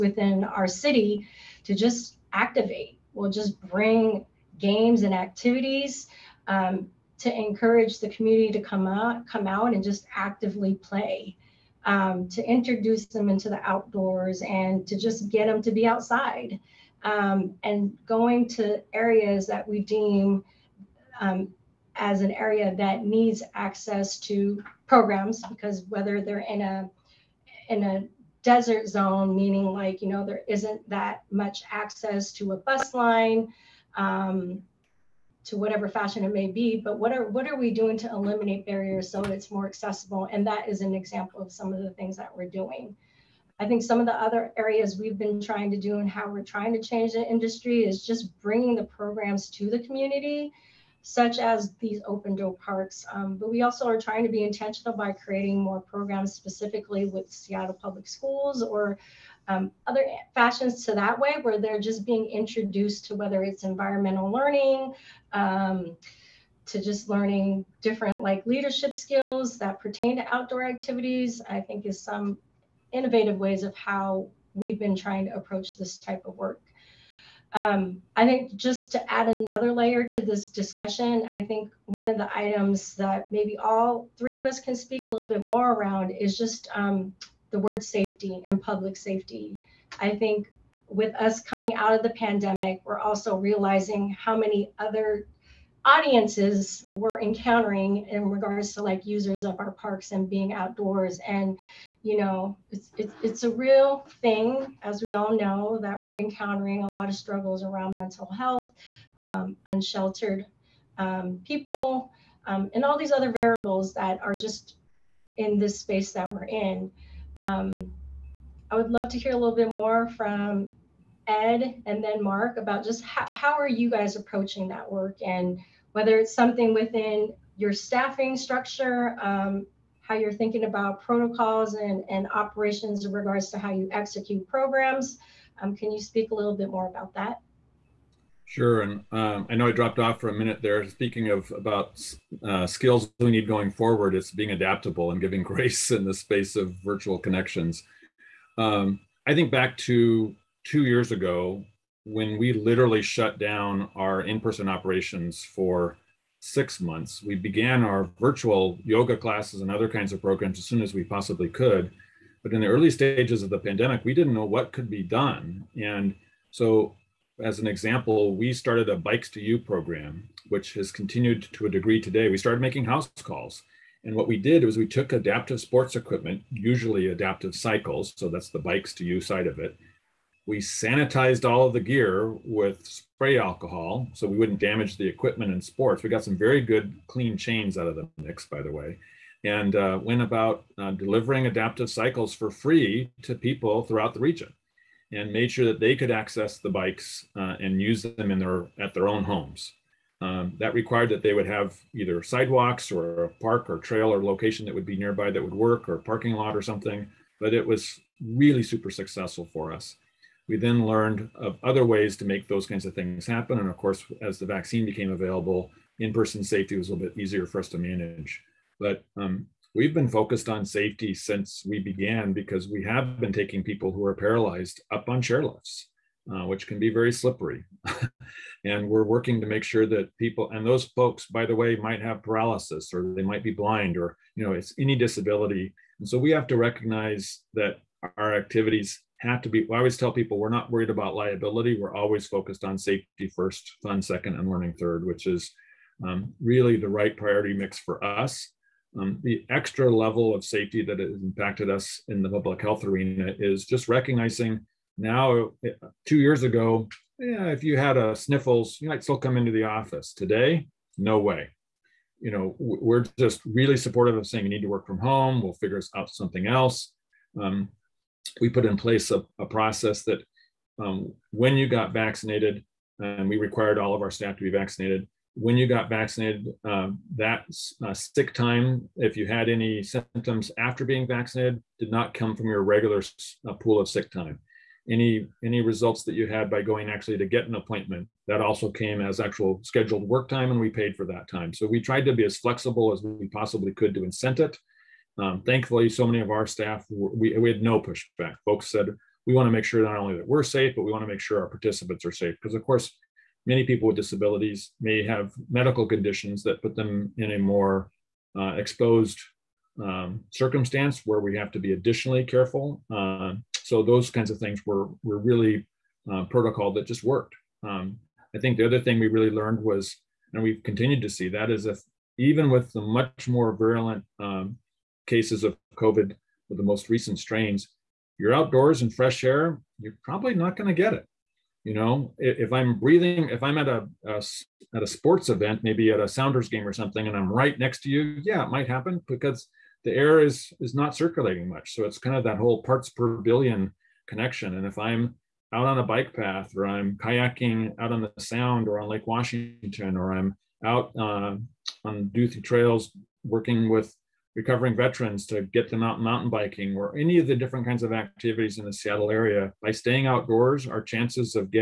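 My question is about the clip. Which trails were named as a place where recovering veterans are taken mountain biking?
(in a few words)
Duthie trails.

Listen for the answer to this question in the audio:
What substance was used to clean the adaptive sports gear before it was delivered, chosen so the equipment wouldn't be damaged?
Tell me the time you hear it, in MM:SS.
03:02.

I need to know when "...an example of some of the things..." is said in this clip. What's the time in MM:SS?
00:40.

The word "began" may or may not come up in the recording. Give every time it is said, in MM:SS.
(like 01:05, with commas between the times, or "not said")
02:37, 03:41.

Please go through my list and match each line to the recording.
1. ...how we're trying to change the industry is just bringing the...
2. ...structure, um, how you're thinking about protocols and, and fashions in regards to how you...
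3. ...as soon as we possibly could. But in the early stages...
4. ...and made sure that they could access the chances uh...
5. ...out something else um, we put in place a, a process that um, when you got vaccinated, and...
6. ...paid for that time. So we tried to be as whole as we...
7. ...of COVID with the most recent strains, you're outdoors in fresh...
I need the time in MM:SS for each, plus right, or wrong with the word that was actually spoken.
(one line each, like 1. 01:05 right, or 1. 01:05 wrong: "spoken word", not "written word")
1. 00:46 right
2. 02:08 wrong: "operations", not "fashions"
3. 02:40 right
4. 03:15 wrong: "bikes", not "chances"
5. 04:25 right
6. 04:50 wrong: "flexible", not "whole"
7. 05:25 right.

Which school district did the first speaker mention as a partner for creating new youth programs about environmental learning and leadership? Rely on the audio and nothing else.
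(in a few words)
Seattle Public Schools.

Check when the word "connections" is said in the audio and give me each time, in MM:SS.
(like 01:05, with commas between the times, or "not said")
02:27, 05:44.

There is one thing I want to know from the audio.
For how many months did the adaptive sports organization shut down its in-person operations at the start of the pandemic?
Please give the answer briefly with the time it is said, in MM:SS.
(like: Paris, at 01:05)
6, at 02:36.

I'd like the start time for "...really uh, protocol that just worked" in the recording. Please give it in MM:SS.
05:15.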